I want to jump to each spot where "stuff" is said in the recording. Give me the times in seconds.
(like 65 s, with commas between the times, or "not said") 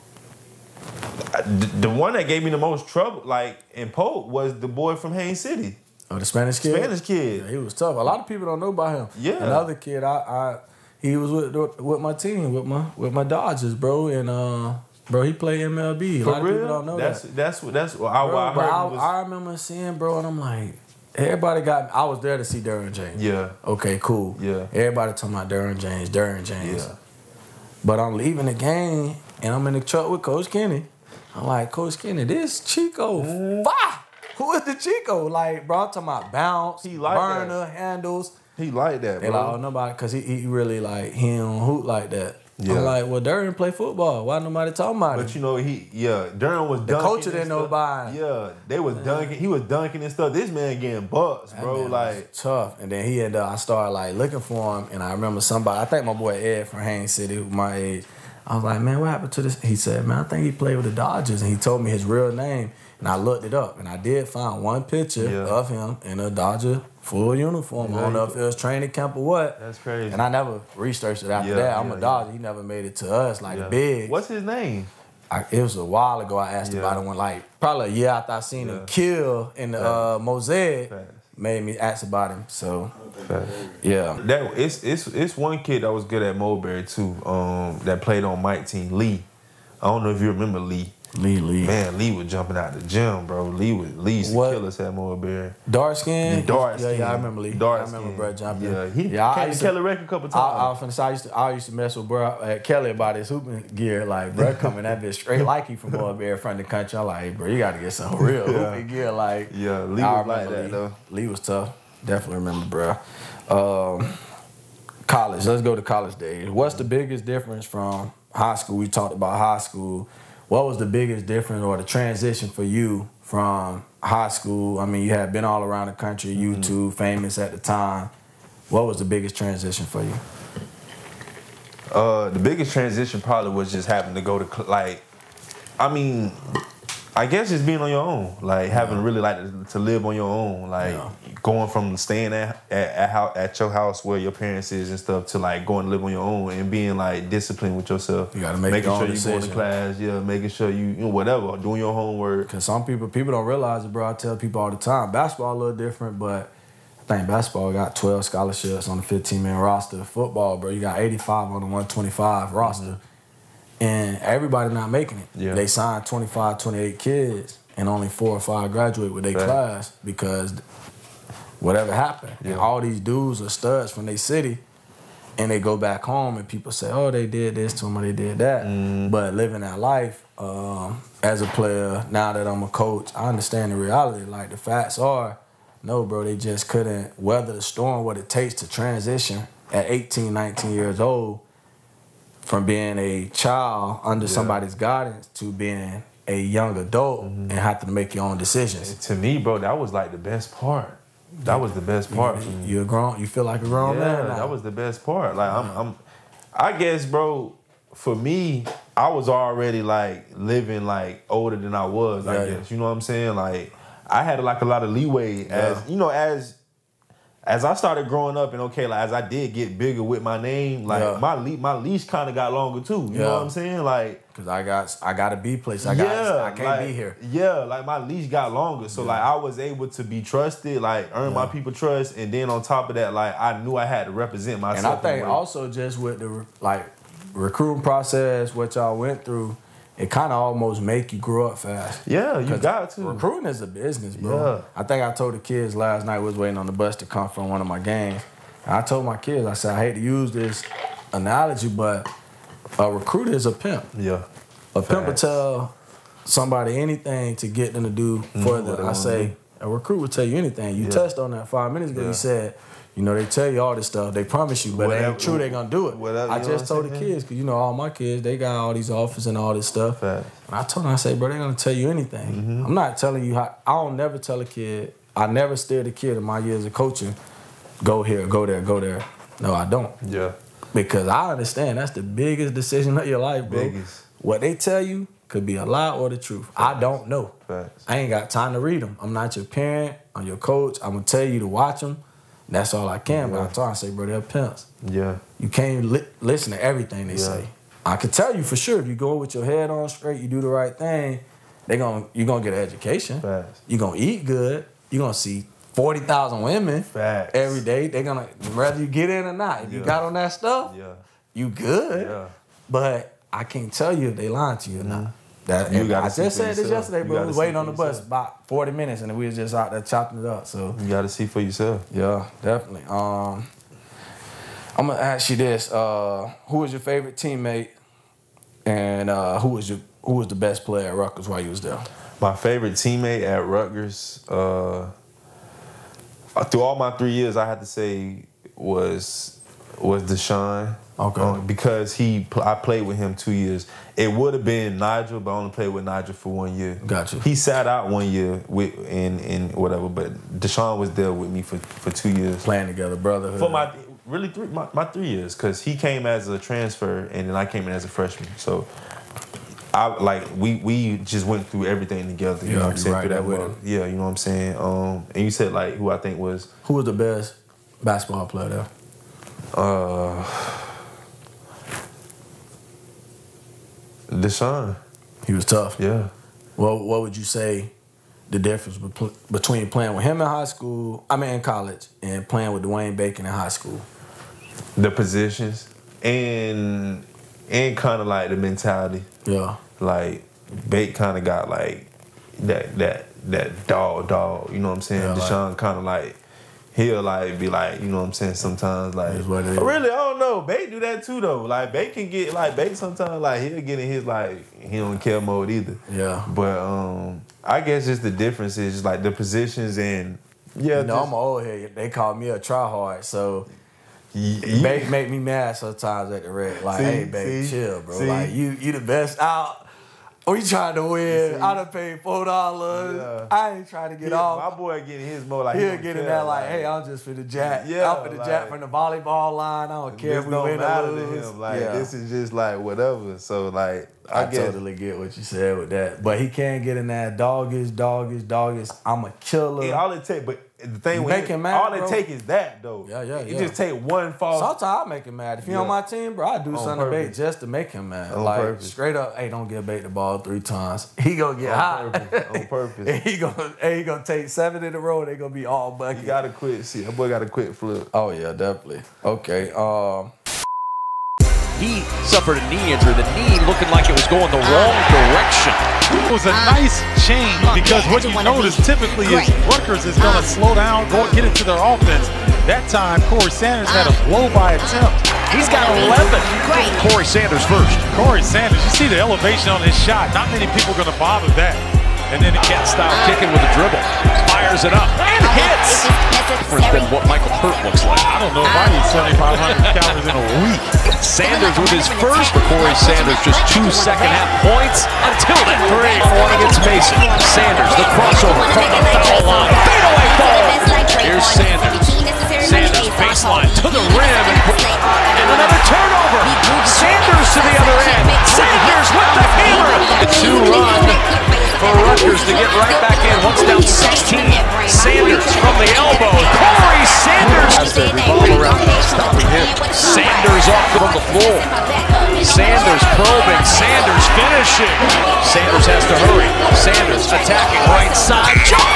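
50 s, 144 s, 263 s, 269 s, 310 s.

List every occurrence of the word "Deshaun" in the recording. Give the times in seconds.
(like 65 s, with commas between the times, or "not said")
340 s, 350 s, 374 s, 395 s.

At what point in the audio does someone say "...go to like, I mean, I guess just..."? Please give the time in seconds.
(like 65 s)
134 s.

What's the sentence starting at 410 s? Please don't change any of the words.
You no, know, I'm old here.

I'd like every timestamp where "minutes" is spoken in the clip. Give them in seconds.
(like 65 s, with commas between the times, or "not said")
261 s, 318 s.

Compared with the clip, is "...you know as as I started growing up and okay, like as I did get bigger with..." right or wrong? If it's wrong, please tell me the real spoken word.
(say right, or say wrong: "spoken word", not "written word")
right.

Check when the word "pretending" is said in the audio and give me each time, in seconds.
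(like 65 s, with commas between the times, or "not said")
not said.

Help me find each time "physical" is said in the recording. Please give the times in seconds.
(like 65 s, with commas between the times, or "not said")
not said.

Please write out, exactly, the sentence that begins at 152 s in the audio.
Cause some people people don't realize it, bro.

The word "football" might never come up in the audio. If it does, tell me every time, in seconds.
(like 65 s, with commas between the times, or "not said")
43 s, 160 s.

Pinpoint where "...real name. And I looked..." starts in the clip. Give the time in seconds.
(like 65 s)
62 s.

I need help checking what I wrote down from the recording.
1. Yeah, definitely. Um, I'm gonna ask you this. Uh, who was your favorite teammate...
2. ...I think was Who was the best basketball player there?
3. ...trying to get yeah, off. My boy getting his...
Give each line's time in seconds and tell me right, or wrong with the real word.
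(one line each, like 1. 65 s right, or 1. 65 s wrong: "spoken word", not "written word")
1. 321 s right
2. 365 s right
3. 423 s right.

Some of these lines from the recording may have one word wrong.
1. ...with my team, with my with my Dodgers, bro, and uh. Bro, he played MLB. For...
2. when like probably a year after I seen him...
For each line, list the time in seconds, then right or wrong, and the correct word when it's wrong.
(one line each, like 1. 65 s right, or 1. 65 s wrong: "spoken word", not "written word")
1. 11 s right
2. 77 s right.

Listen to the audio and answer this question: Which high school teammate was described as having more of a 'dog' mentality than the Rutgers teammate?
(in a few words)
Dwayne Bacon.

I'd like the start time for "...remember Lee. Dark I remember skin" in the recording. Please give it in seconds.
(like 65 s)
97 s.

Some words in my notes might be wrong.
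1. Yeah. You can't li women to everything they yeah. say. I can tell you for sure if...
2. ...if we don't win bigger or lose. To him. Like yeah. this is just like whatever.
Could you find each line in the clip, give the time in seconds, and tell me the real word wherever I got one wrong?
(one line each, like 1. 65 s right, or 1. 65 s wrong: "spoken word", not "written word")
1. 294 s wrong: "listen", not "women"
2. 430 s wrong: "matter", not "bigger".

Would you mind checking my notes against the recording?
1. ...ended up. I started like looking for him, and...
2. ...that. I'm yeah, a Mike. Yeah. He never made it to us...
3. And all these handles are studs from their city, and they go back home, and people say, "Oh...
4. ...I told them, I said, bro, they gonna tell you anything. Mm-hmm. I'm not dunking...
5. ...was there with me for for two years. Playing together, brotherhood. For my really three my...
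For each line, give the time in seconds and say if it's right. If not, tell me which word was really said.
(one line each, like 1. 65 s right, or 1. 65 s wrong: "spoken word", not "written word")
1. 53 s right
2. 71 s wrong: "Dodger", not "Mike"
3. 172 s wrong: "dudes", not "handles"
4. 270 s wrong: "telling", not "dunking"
5. 350 s right.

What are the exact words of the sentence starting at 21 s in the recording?
I was there to see Derwin James.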